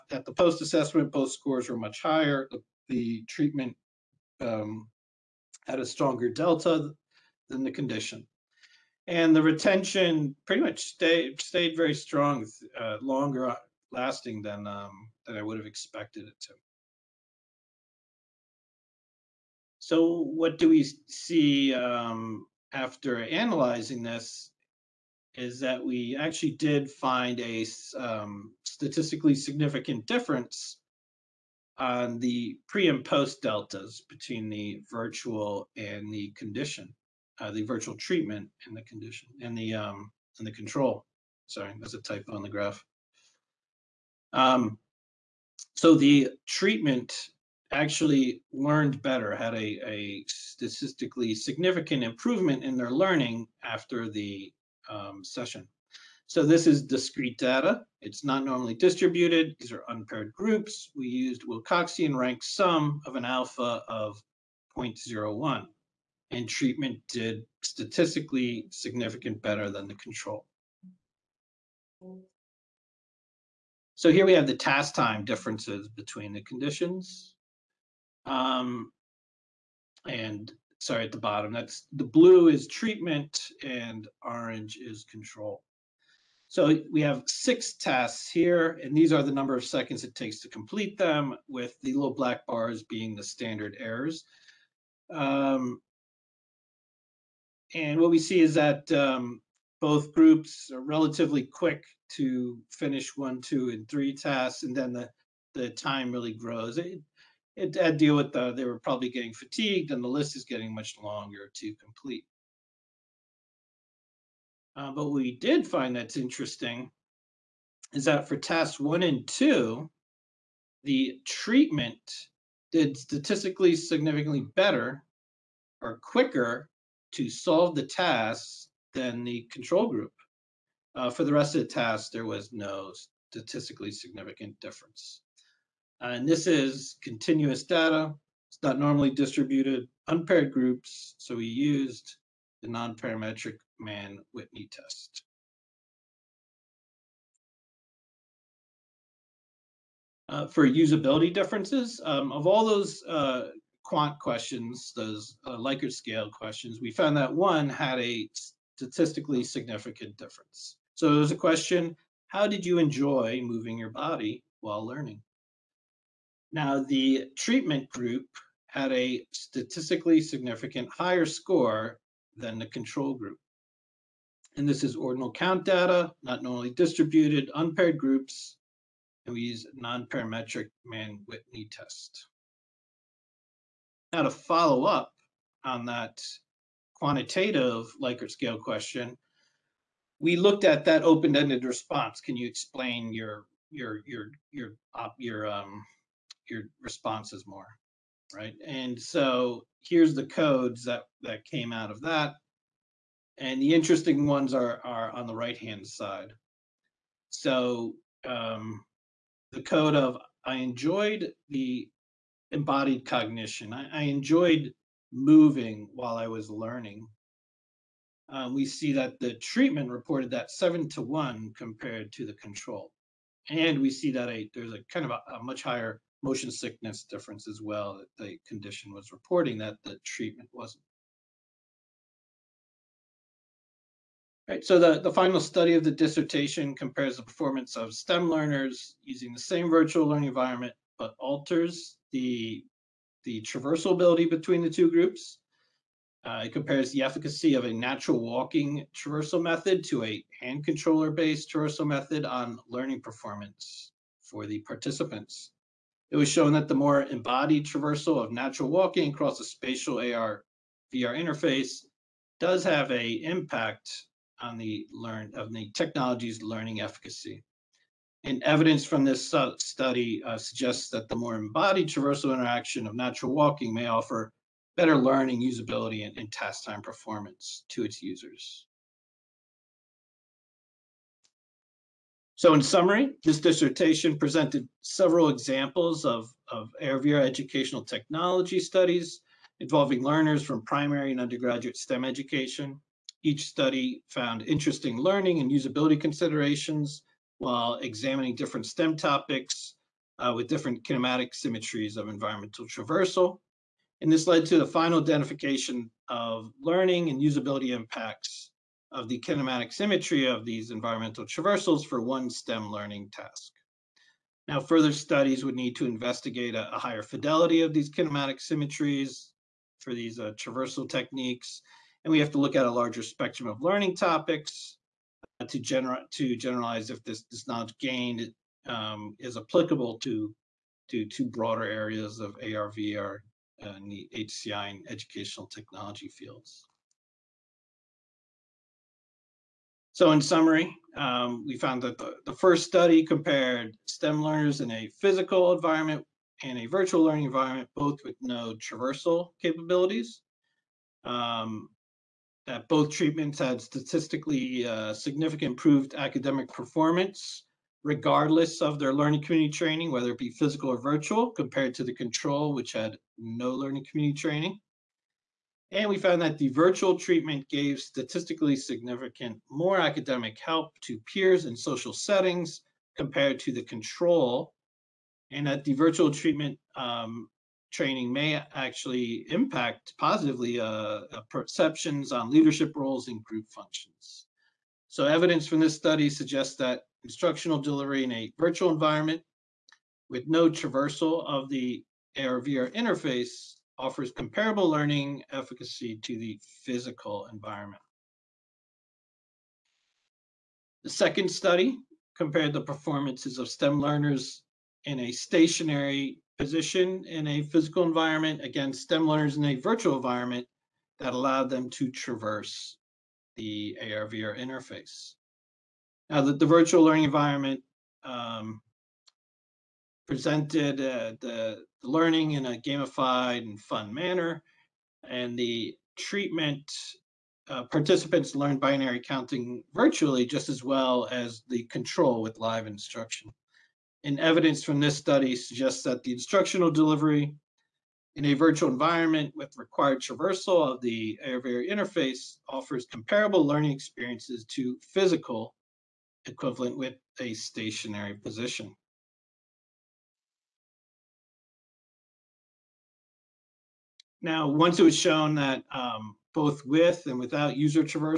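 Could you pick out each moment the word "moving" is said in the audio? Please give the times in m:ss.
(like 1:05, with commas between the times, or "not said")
2:43, 3:35.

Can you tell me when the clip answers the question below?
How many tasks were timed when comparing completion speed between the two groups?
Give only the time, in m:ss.
1:27.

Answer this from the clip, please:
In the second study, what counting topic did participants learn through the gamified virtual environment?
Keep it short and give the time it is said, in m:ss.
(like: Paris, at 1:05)
Binary counting, at 7:08.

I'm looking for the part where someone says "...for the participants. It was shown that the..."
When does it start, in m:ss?
4:14.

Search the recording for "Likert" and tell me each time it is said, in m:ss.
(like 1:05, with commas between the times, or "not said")
2:35, 3:08.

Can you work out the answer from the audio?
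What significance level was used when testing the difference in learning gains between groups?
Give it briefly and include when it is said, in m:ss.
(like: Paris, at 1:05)
0.01, at 1:04.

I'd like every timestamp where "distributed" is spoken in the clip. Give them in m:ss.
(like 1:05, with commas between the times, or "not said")
0:58, 2:19, 2:56.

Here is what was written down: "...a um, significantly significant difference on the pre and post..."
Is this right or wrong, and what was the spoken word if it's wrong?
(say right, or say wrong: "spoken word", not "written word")
wrong: "statistically", not "significantly".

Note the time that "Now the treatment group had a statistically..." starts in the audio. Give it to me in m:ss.
2:46.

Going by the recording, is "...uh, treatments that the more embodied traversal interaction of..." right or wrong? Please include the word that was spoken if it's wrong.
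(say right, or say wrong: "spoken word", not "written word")
wrong: "suggests", not "treatments".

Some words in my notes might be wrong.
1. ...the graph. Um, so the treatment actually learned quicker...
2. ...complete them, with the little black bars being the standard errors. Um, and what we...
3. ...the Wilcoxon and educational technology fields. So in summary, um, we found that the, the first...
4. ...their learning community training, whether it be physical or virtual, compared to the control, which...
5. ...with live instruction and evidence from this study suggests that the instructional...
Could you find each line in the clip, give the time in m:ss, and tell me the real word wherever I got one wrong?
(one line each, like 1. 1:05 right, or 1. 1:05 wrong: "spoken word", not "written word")
1. 0:42 wrong: "better", not "quicker"
2. 1:30 right
3. 5:33 wrong: "HCI", not "Wilcoxon"
4. 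5:58 right
5. 7:12 right.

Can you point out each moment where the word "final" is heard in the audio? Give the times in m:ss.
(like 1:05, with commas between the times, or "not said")
3:55, 5:04.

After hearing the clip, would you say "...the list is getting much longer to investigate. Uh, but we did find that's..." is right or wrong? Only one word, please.
wrong.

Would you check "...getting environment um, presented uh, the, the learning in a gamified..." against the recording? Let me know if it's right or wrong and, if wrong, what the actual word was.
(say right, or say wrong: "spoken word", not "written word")
wrong: "learning", not "getting".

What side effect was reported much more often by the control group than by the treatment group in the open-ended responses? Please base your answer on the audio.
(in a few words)
Motion sickness.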